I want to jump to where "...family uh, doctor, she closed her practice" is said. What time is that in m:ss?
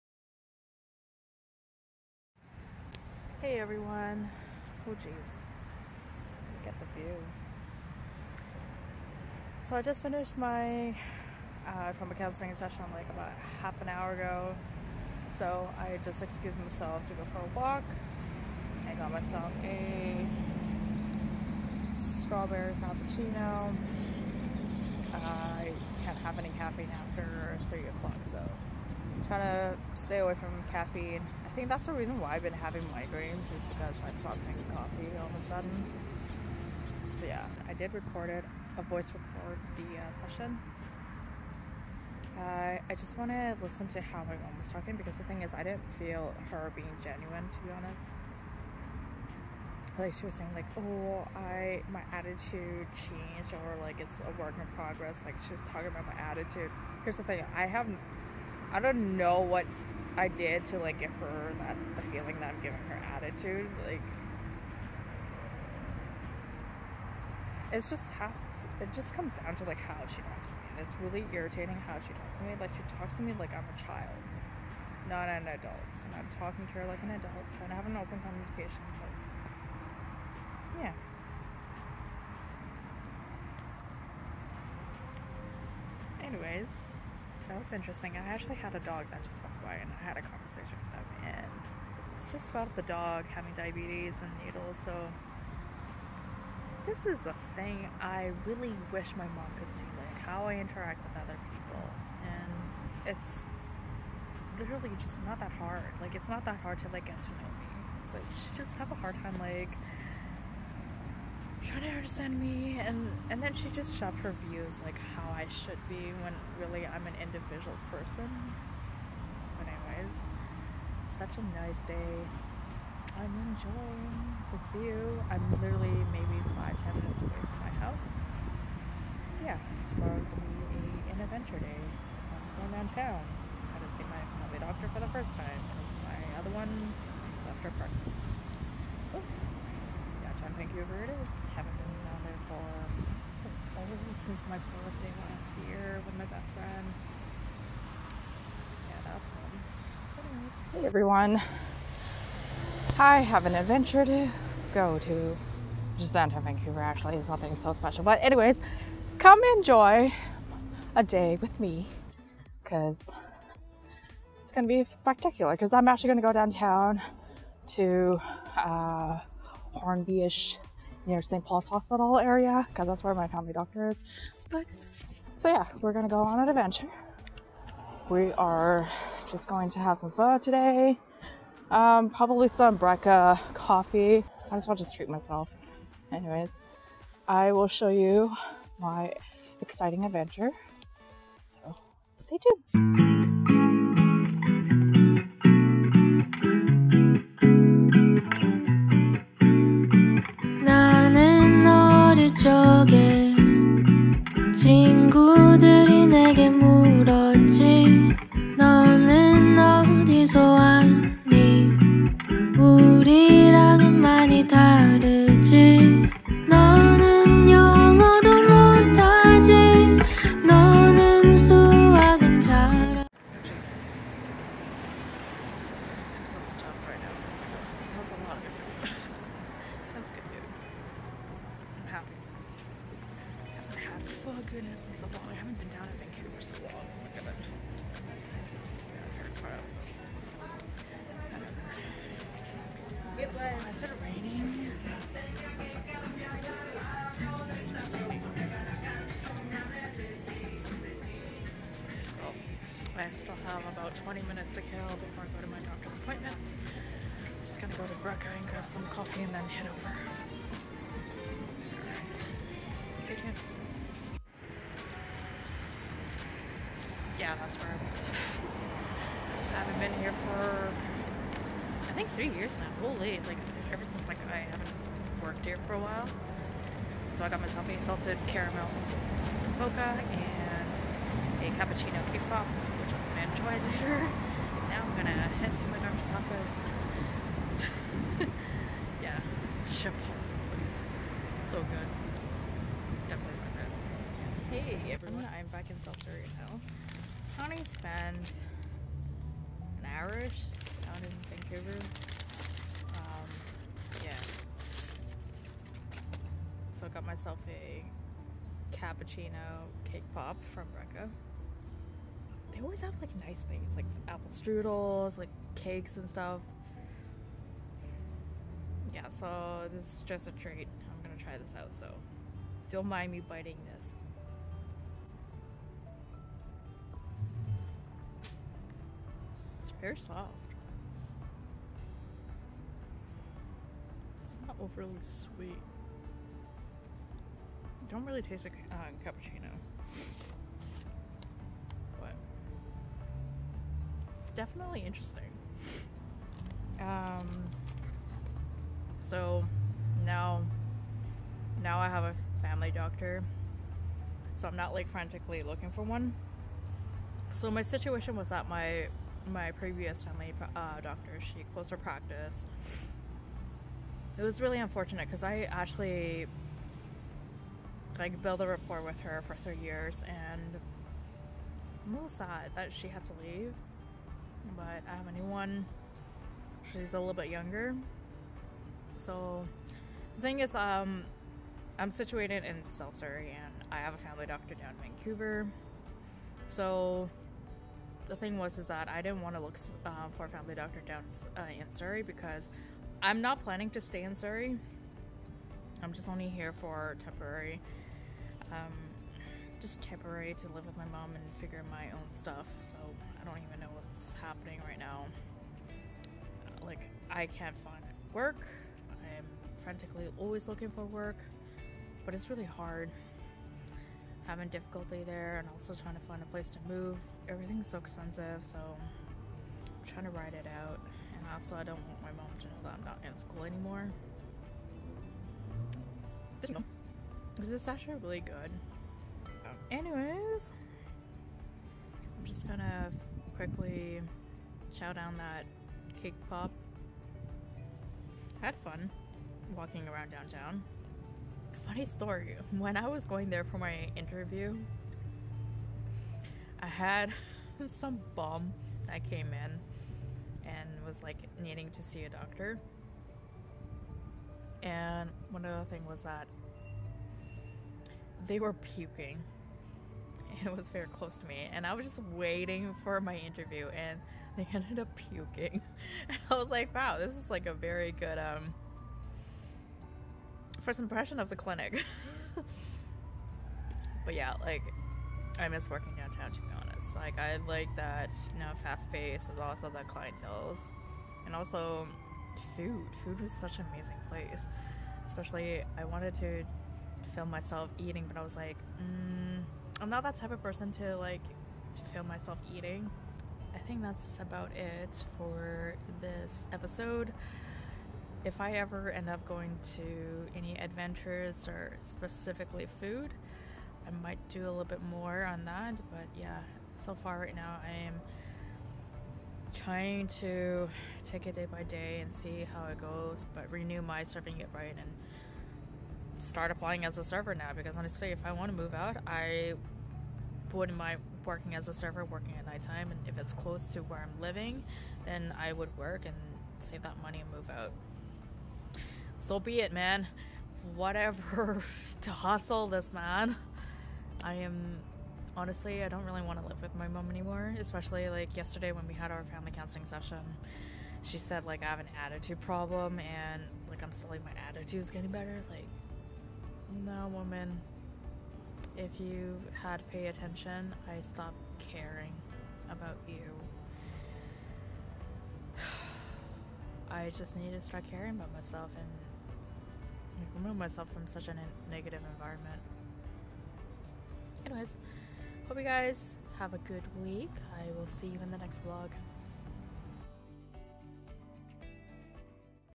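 6:00.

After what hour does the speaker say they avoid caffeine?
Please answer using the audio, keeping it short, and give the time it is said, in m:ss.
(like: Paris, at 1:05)
3 o'clock, at 0:27.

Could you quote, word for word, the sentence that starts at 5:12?
They always have like nice things, like apple strudels, like cakes and stuff.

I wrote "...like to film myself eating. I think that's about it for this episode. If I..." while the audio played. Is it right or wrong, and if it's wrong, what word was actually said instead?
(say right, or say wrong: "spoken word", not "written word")
right.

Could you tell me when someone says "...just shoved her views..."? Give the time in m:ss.
1:53.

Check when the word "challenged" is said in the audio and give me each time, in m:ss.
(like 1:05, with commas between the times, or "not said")
not said.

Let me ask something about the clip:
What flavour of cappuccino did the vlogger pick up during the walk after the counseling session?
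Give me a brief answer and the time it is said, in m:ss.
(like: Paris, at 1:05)
Strawberry, at 0:21.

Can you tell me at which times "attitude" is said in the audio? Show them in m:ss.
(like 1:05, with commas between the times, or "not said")
0:52, 0:56, 1:03, 9:02.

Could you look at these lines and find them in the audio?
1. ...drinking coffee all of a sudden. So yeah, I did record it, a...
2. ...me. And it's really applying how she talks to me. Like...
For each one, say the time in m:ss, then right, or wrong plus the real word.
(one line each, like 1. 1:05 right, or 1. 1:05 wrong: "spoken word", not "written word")
1. 0:34 right
2. 1:10 wrong: "irritating", not "applying".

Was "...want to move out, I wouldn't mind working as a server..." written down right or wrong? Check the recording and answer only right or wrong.
right.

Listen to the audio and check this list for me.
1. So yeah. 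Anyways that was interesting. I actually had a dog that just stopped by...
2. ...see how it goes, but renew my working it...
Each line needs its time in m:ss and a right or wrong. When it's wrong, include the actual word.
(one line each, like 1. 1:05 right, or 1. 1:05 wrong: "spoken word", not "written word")
1. 1:18 wrong: "walked", not "stopped"
2. 8:32 wrong: "serving", not "working".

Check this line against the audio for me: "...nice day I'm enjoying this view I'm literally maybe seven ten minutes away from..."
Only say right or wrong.
wrong.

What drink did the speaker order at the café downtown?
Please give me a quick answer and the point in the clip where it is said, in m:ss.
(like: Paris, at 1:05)
Salted caramel mocha, at 4:37.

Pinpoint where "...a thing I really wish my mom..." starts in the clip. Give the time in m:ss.
1:37.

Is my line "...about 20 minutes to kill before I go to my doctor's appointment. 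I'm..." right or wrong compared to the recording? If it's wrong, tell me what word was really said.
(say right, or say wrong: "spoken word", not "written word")
right.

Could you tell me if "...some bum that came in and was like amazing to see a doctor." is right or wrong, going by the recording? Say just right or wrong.
wrong.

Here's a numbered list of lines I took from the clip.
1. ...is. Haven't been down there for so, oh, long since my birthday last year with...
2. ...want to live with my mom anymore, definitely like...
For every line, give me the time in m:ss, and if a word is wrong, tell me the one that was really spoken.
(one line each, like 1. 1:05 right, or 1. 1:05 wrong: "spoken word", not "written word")
1. 2:21 right
2. 8:56 wrong: "especially", not "definitely".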